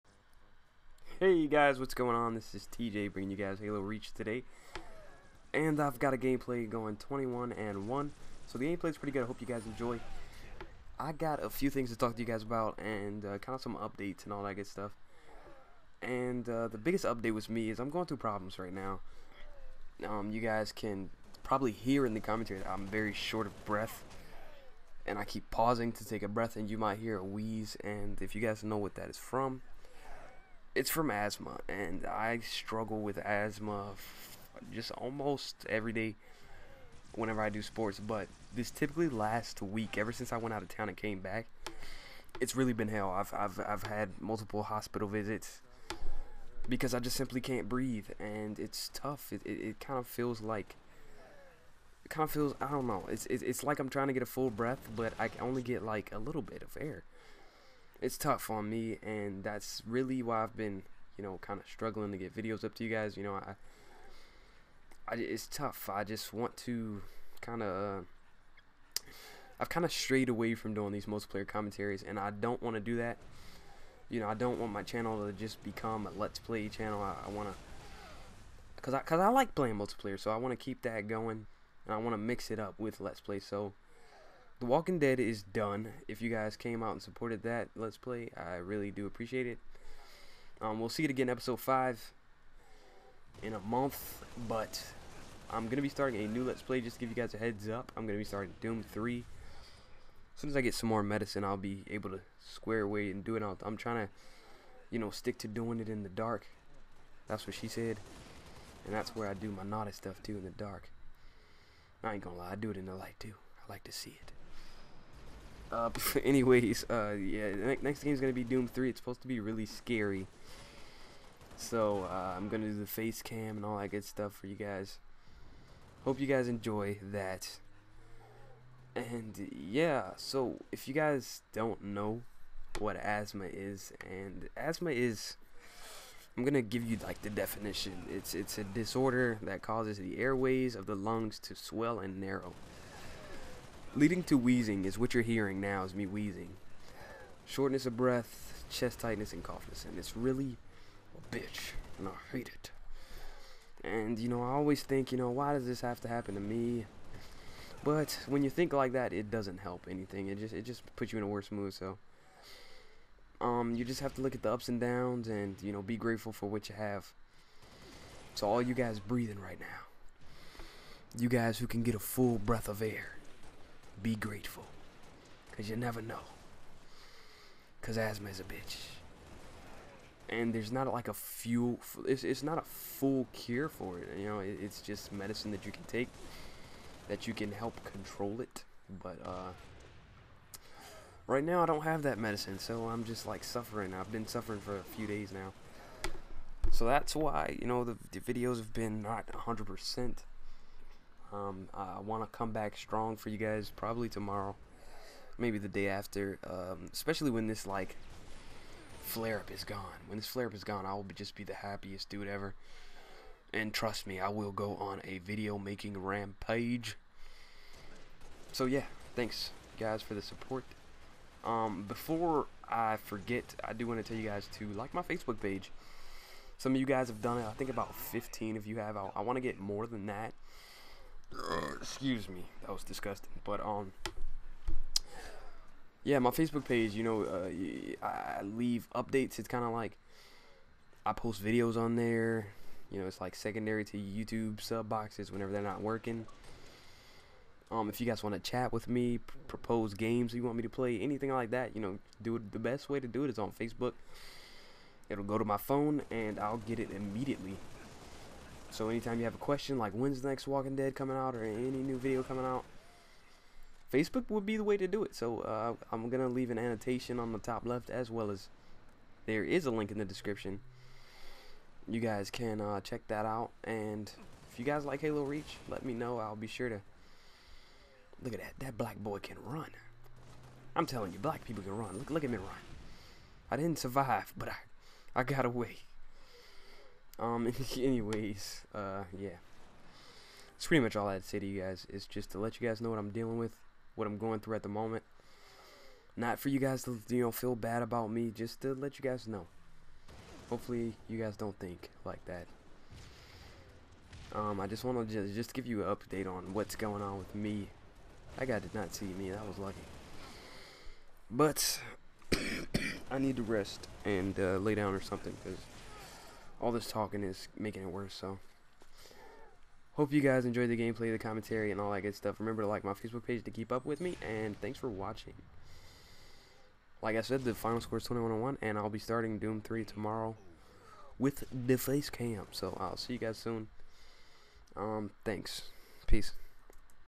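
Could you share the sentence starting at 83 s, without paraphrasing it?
So, the Walking Dead is done.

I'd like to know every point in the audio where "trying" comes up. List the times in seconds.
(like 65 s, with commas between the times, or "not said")
53 s, 103 s.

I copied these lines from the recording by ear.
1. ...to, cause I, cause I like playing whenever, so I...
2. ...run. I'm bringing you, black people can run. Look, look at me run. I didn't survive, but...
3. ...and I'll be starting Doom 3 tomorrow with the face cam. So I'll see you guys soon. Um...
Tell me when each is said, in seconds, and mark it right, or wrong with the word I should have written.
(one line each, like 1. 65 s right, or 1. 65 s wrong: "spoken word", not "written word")
1. 77 s wrong: "multiplayer", not "whenever"
2. 279 s wrong: "telling", not "bringing"
3. 328 s right.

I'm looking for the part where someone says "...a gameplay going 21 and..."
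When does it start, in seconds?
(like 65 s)
6 s.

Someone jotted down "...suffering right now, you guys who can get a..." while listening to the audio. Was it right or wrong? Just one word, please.
wrong.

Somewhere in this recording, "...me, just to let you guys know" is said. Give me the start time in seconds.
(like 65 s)
298 s.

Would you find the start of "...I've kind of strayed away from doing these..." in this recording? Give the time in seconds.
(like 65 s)
69 s.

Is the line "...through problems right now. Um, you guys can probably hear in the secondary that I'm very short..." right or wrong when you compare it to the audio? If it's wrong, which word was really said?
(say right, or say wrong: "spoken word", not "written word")
wrong: "commentary", not "secondary".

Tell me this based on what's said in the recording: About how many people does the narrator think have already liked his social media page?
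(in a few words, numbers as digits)
15.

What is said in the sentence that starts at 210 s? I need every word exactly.
When this flare up is gone, I will just be the happiest dude ever.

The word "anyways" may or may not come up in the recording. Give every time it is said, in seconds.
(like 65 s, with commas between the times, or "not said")
116 s, 287 s.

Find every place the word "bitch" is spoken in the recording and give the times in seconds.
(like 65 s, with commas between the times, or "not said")
151 s, 178 s.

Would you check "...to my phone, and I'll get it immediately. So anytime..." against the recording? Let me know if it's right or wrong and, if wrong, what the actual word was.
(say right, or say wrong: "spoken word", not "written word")
right.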